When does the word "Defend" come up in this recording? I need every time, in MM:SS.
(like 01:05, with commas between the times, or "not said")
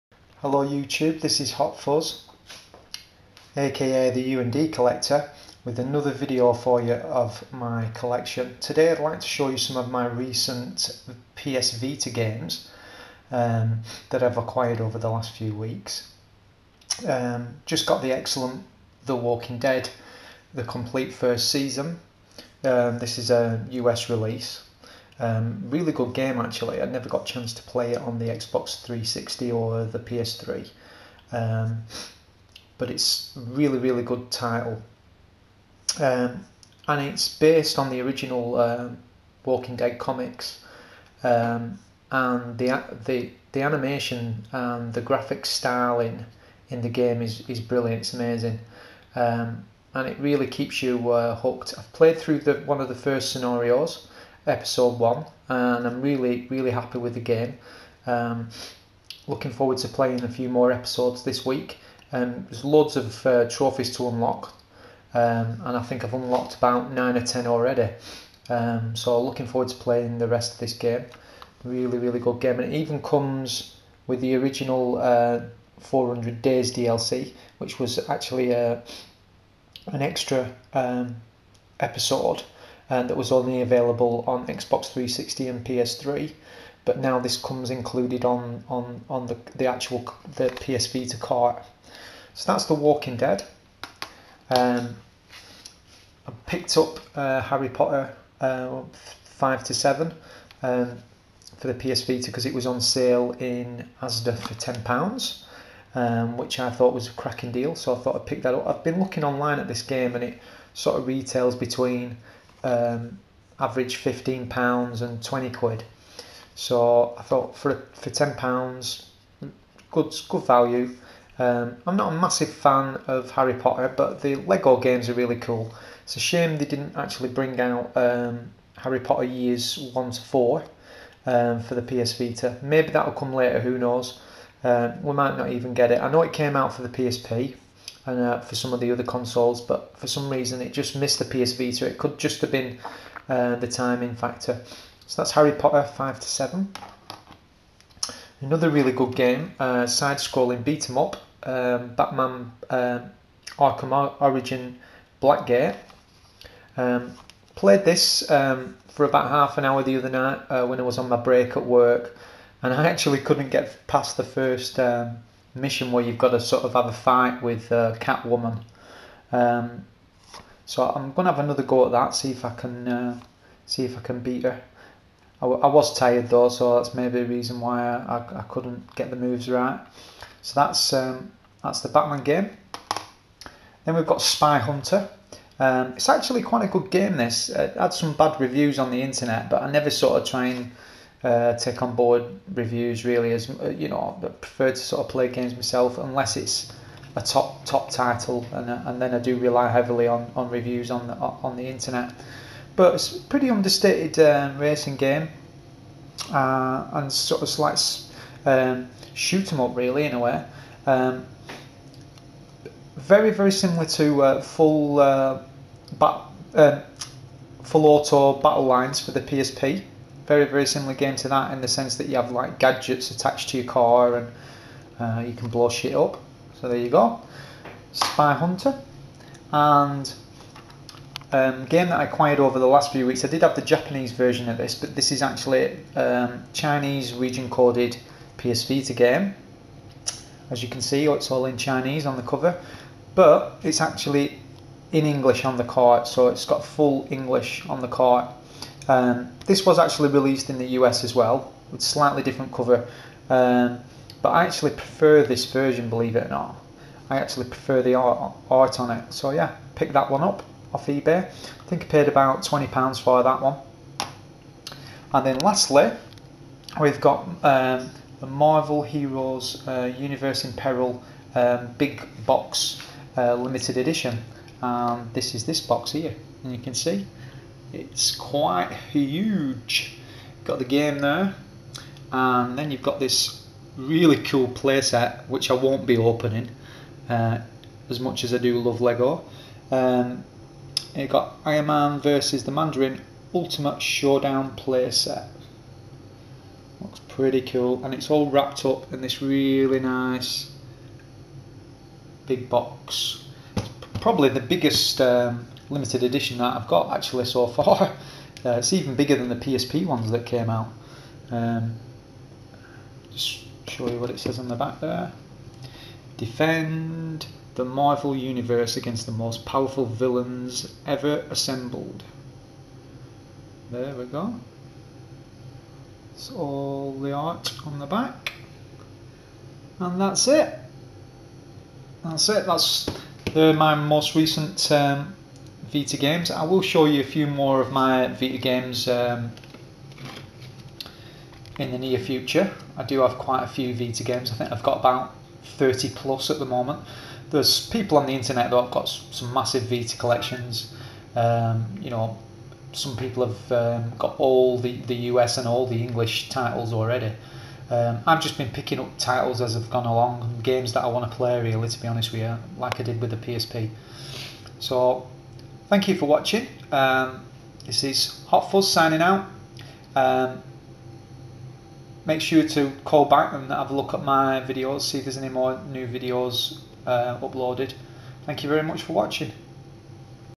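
05:16.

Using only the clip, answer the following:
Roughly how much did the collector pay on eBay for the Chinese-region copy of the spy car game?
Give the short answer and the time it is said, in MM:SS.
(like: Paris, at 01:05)
£20, at 04:22.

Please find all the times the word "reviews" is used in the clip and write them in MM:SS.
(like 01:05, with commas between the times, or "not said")
03:08, 03:12, 03:20.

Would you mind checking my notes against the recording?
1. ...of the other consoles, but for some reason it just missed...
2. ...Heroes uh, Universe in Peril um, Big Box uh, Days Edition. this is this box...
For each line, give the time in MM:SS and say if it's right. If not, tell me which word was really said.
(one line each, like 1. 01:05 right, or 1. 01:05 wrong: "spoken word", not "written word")
1. 02:18 right
2. 04:28 wrong: "Limited", not "Days".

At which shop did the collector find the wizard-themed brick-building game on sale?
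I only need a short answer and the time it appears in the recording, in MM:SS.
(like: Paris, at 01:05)
ASDA, at 01:44.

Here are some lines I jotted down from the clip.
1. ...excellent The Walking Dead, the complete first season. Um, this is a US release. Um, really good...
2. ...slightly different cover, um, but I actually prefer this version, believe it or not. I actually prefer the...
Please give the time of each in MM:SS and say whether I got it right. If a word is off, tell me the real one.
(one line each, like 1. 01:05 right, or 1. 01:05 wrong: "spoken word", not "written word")
1. 00:18 right
2. 04:11 right.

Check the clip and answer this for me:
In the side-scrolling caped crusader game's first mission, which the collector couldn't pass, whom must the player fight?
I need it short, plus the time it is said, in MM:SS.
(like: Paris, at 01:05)
Catwoman, at 02:47.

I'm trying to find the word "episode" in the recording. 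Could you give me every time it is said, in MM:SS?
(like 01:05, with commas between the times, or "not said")
00:54, 01:00, 01:21.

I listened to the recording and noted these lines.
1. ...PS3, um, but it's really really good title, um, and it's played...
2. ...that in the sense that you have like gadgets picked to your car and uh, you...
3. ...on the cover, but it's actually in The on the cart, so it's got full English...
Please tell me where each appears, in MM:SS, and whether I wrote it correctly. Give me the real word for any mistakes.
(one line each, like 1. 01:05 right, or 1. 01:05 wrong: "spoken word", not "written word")
1. 00:29 wrong: "based", not "played"
2. 03:41 wrong: "attached", not "picked"
3. 04:02 wrong: "English", not "The".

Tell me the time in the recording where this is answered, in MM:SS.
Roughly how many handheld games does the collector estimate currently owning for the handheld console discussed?
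05:45.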